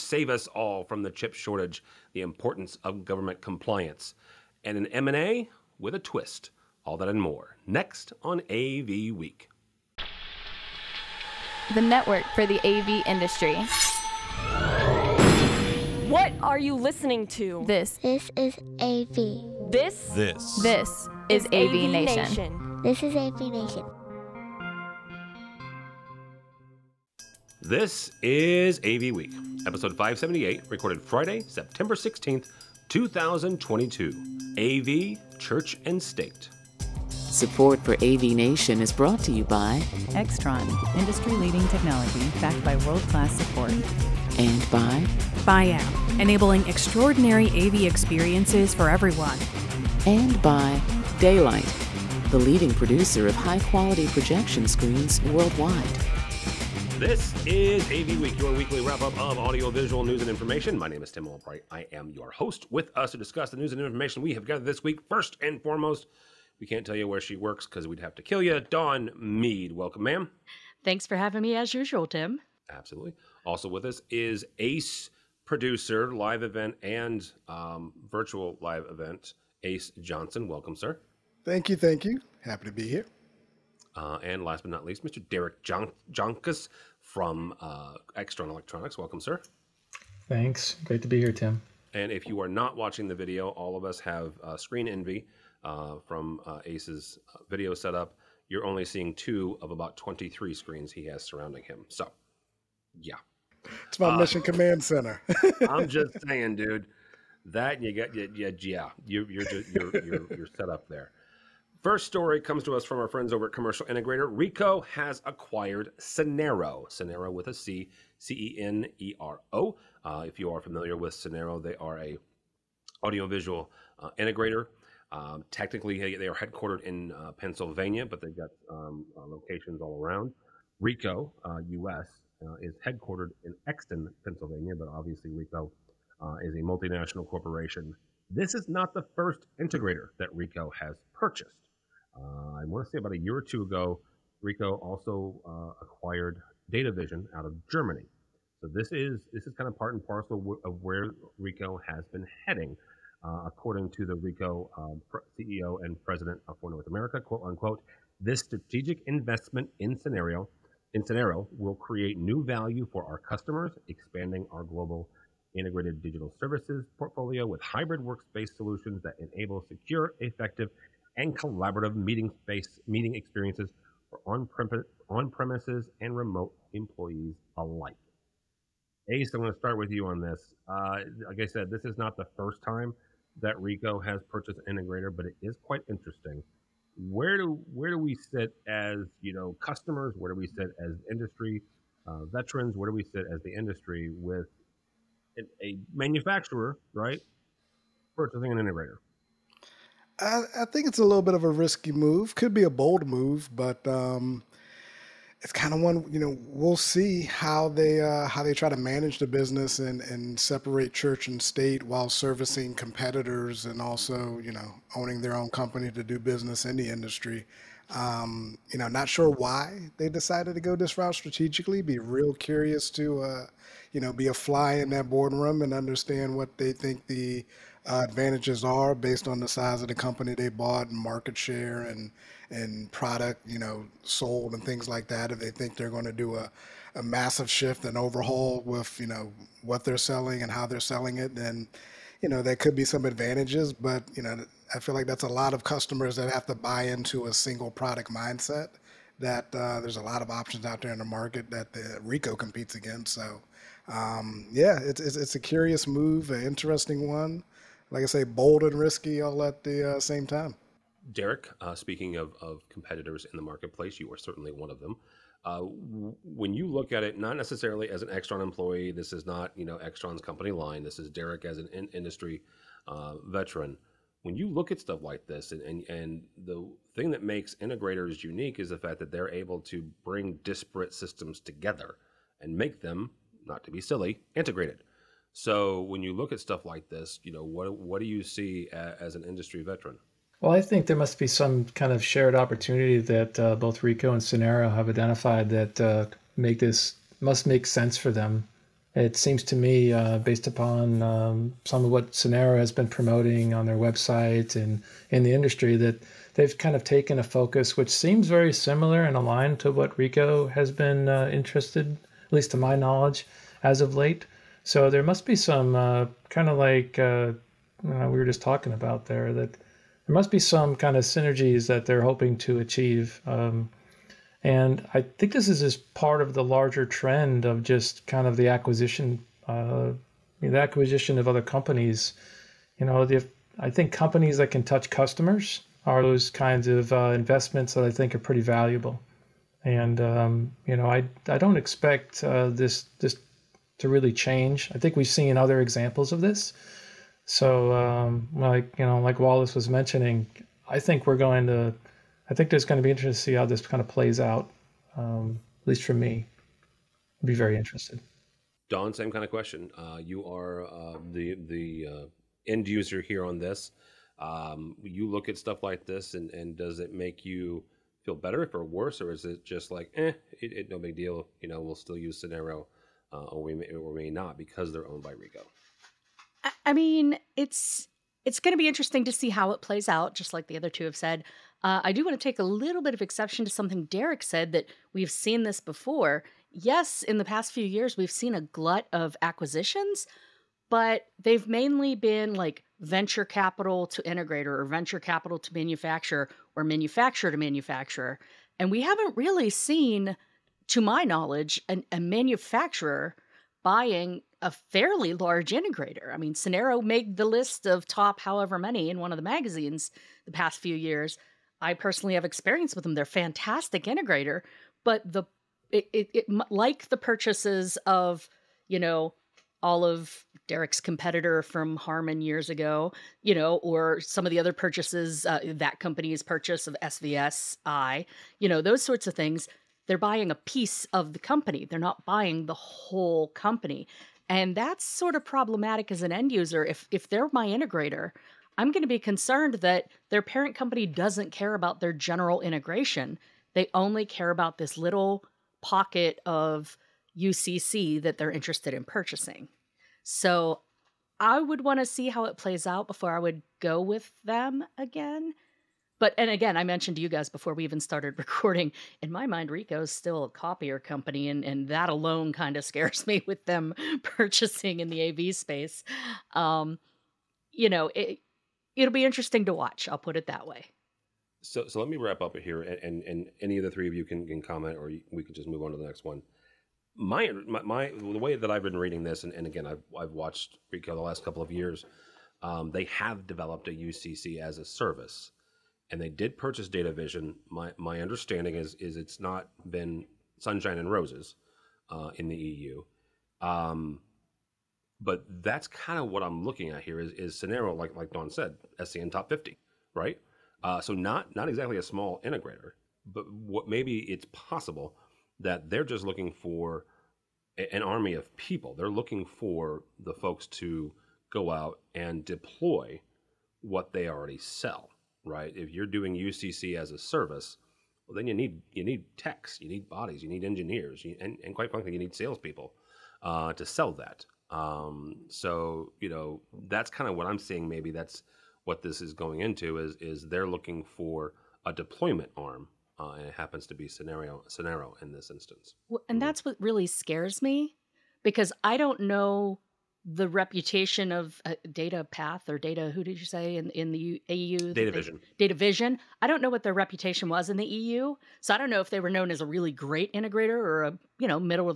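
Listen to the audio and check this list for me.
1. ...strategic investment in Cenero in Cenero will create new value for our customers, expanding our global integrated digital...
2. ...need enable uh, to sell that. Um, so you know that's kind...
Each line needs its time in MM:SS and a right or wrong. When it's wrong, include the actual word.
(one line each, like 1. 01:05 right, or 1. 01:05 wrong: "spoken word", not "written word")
1. 02:38 right
2. 08:41 wrong: "salespeople", not "enable".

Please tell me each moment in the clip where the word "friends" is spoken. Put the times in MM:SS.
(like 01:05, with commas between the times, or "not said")
01:53.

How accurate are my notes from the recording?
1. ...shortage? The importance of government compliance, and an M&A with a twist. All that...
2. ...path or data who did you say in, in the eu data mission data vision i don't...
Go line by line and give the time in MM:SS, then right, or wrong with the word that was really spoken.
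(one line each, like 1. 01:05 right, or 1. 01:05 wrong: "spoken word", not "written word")
1. 00:01 right
2. 09:02 wrong: "vision", not "mission".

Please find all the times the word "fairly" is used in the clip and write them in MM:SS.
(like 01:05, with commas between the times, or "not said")
06:44.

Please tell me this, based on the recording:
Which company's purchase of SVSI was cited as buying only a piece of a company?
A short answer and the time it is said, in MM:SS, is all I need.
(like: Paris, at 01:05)
Harman, at 07:01.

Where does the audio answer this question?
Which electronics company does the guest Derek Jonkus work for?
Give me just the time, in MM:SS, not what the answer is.
01:28.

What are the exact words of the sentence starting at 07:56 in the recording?
My, my, my the way that I've been reading this, and, and again, I've, I've watched Ricoh the last couple of years.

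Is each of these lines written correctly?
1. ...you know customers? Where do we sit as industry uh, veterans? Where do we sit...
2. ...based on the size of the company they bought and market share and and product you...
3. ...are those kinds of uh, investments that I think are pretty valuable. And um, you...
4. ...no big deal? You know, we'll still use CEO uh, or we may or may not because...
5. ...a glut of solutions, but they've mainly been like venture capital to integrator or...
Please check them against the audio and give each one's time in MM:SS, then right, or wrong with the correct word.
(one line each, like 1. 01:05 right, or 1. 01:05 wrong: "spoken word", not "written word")
1. 03:09 right
2. 03:48 right
3. 05:35 right
4. 06:10 wrong: "Cenero", not "CEO"
5. 06:28 wrong: "acquisitions", not "solutions".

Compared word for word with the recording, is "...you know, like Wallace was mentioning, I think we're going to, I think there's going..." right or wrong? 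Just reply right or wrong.
right.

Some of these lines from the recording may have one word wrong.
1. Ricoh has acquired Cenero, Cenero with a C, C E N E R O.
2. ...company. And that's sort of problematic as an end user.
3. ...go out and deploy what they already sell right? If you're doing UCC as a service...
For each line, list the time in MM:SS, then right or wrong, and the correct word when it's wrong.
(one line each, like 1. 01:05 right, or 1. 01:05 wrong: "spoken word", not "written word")
1. 01:54 right
2. 07:13 right
3. 08:31 right.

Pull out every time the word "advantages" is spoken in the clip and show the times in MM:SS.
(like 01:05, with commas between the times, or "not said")
03:48, 04:03.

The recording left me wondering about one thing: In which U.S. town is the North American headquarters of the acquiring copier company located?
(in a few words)
Exton, Pennsylvania.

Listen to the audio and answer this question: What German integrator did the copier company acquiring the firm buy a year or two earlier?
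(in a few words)
DataVision.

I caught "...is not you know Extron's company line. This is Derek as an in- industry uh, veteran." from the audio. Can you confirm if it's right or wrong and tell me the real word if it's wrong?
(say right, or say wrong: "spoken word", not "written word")
right.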